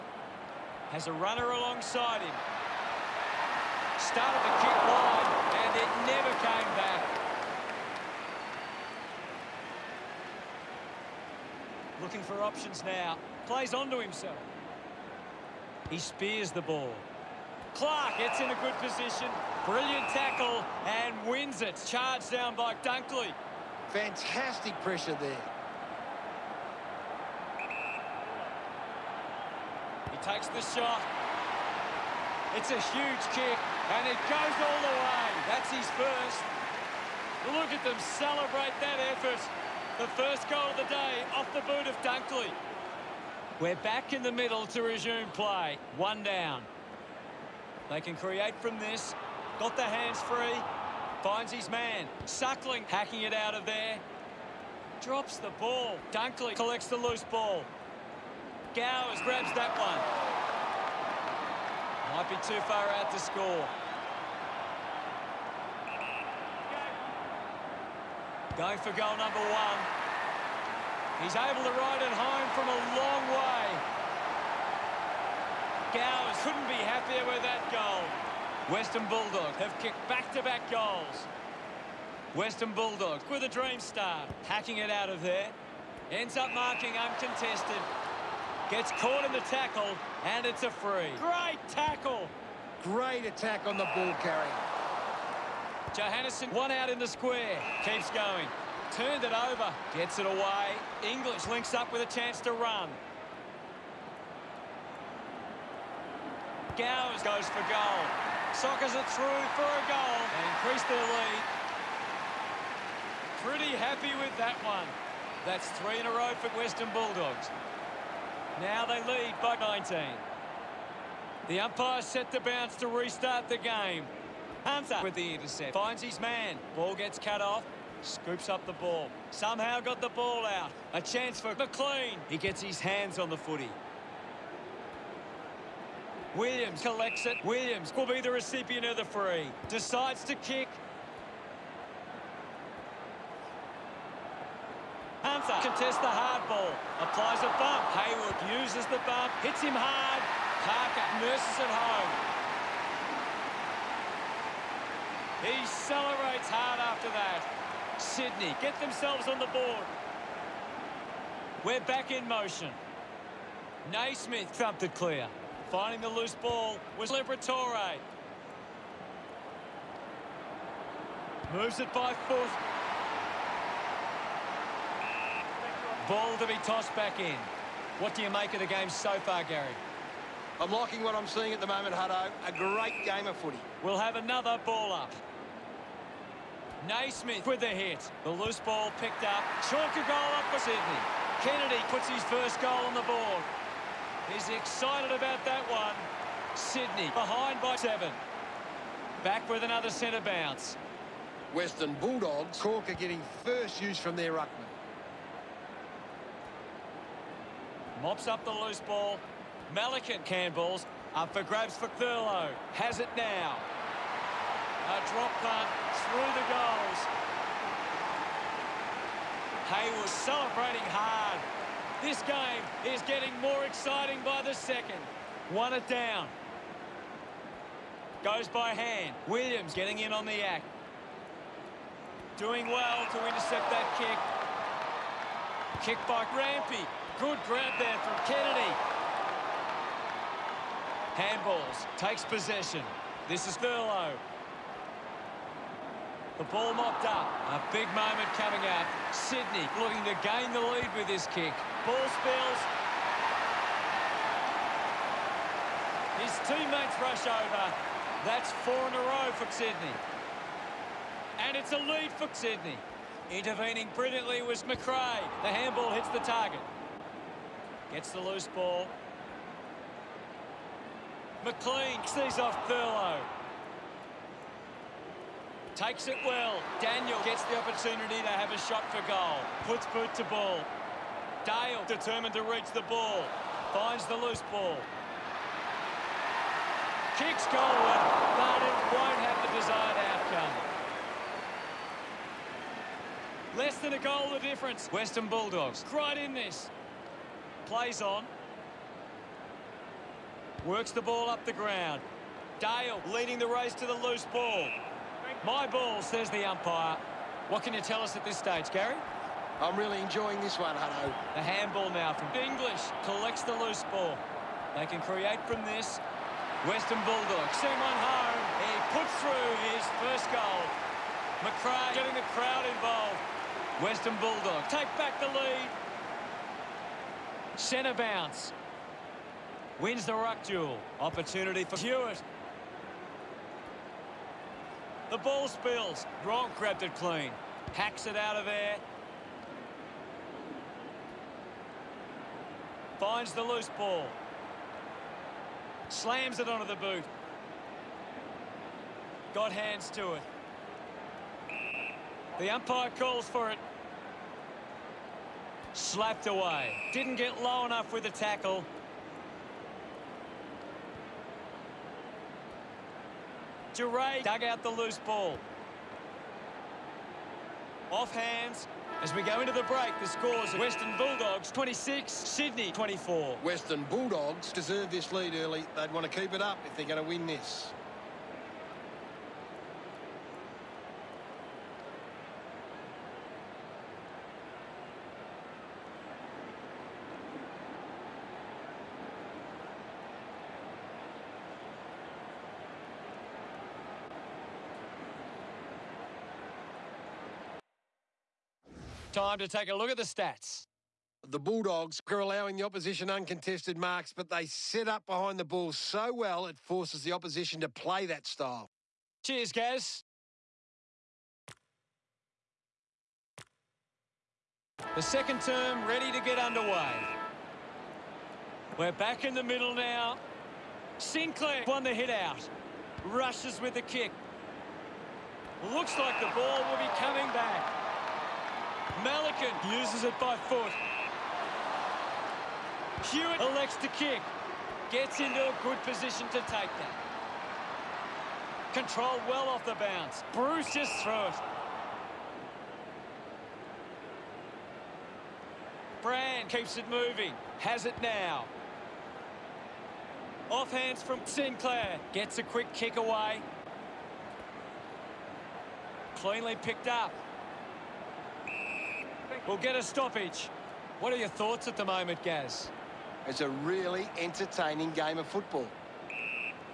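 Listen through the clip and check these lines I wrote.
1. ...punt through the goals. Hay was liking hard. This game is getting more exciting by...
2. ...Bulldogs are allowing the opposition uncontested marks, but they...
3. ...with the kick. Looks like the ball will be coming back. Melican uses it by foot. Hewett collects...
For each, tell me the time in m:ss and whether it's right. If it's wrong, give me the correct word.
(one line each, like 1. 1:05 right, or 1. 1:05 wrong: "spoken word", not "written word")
1. 3:35 wrong: "celebrating", not "liking"
2. 6:41 right
3. 7:03 wrong: "elects", not "collects".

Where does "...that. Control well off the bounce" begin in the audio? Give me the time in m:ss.
7:16.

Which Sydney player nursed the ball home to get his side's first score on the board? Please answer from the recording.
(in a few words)
Parker.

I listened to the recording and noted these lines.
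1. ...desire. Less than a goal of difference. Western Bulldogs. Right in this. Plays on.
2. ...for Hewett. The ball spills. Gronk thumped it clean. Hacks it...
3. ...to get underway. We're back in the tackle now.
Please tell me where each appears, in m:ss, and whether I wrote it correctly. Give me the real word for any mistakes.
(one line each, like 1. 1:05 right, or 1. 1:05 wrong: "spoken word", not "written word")
1. 4:49 right
2. 5:31 wrong: "grabbed", not "thumped"
3. 6:56 wrong: "middle", not "tackle".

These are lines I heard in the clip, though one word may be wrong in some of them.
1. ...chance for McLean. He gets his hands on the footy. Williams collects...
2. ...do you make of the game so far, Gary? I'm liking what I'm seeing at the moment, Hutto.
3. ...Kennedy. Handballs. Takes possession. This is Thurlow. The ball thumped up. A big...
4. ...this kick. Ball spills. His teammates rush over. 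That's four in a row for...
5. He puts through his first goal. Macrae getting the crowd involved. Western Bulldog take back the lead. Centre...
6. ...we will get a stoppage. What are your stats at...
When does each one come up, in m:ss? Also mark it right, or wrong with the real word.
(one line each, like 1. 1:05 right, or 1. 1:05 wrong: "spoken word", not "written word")
1. 2:11 right
2. 2:58 right
3. 3:58 wrong: "mopped", not "thumped"
4. 4:11 right
5. 5:18 right
6. 7:39 wrong: "thoughts", not "stats".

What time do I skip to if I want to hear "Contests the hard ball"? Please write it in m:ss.
2:25.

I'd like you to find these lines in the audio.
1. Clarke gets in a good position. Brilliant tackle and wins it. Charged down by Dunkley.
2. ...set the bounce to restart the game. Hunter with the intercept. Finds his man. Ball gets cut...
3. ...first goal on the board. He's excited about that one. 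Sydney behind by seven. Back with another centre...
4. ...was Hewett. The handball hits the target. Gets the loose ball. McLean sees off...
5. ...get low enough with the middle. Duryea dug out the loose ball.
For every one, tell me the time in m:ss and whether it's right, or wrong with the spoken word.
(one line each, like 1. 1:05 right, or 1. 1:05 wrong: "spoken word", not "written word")
1. 0:17 right
2. 2:02 right
3. 3:12 right
4. 4:24 wrong: "Macrae", not "Hewett"
5. 5:57 wrong: "tackle", not "middle".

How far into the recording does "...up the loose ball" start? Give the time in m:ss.
3:28.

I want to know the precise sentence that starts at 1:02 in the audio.
Might be too far out to score.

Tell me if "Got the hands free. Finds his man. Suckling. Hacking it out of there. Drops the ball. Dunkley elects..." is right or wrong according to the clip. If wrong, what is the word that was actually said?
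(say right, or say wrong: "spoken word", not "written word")
wrong: "collects", not "elects".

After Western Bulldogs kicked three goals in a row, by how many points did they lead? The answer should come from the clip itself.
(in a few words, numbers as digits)
19.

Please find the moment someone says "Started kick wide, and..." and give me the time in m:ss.
0:04.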